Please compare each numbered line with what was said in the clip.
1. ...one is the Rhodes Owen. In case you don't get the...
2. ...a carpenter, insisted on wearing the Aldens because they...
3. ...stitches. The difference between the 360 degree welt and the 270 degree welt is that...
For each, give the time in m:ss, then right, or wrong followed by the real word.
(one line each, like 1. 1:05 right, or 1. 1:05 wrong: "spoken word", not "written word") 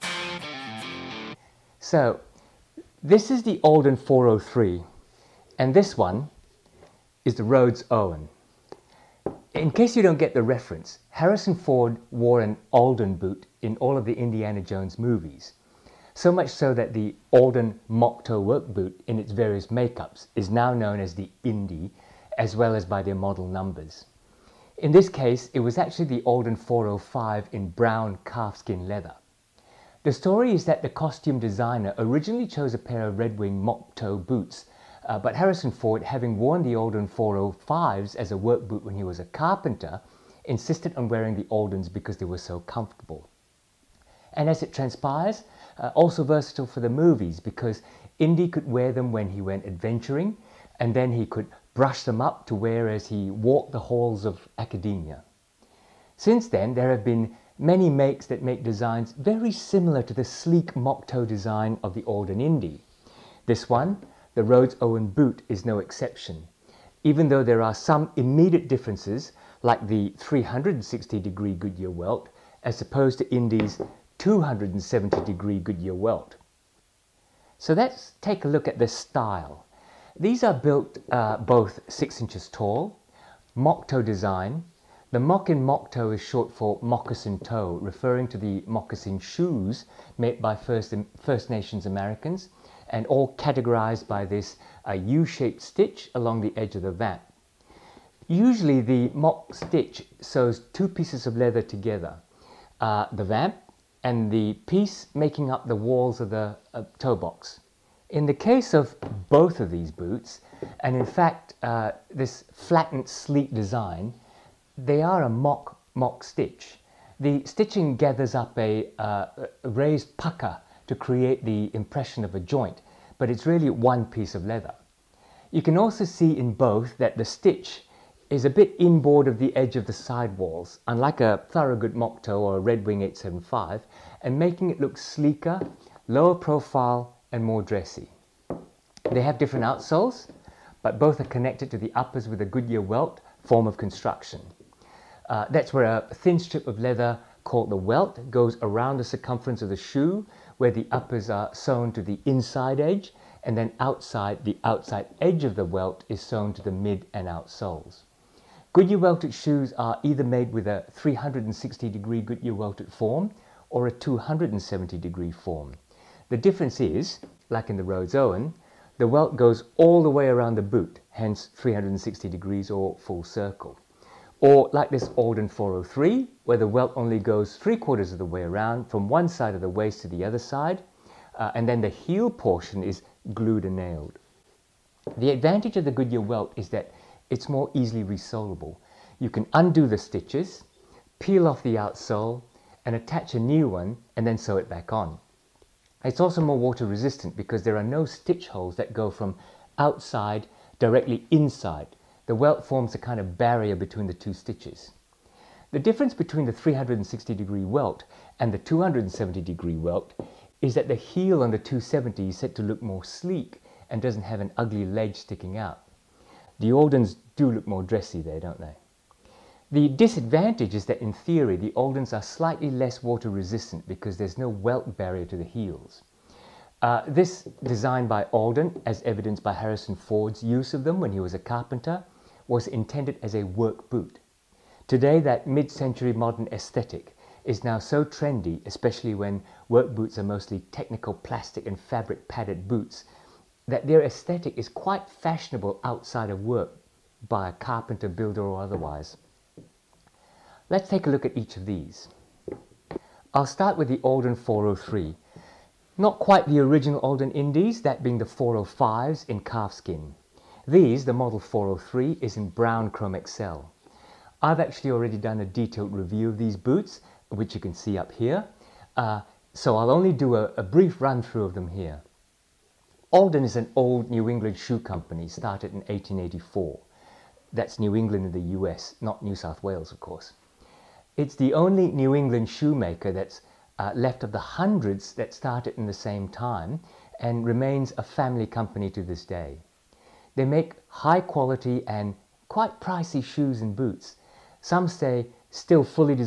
1. 0:05 right
2. 0:39 right
3. 3:24 right.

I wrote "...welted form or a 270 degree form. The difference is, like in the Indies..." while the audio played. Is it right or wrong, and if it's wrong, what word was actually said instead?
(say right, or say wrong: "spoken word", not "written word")
wrong: "Rhodes", not "Indies".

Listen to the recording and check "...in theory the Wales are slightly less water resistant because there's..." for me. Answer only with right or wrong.
wrong.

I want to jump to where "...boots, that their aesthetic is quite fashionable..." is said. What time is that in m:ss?
4:02.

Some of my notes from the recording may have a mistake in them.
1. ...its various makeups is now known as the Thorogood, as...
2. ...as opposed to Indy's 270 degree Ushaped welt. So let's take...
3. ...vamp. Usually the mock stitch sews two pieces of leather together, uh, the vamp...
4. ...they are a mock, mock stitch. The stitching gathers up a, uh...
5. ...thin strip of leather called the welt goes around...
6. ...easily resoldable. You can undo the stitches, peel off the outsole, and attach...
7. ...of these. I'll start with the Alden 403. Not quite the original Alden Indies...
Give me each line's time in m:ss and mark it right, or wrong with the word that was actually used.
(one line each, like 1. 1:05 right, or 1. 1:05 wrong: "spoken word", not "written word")
1. 0:19 wrong: "Indy", not "Thorogood"
2. 1:12 wrong: "Goodyear", not "Ushaped"
3. 1:36 right
4. 1:54 right
5. 2:26 right
6. 3:07 right
7. 4:11 right.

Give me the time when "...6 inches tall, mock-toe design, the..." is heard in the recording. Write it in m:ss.
1:21.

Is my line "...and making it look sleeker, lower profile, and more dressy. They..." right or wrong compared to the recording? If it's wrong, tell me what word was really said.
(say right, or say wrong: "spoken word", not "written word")
right.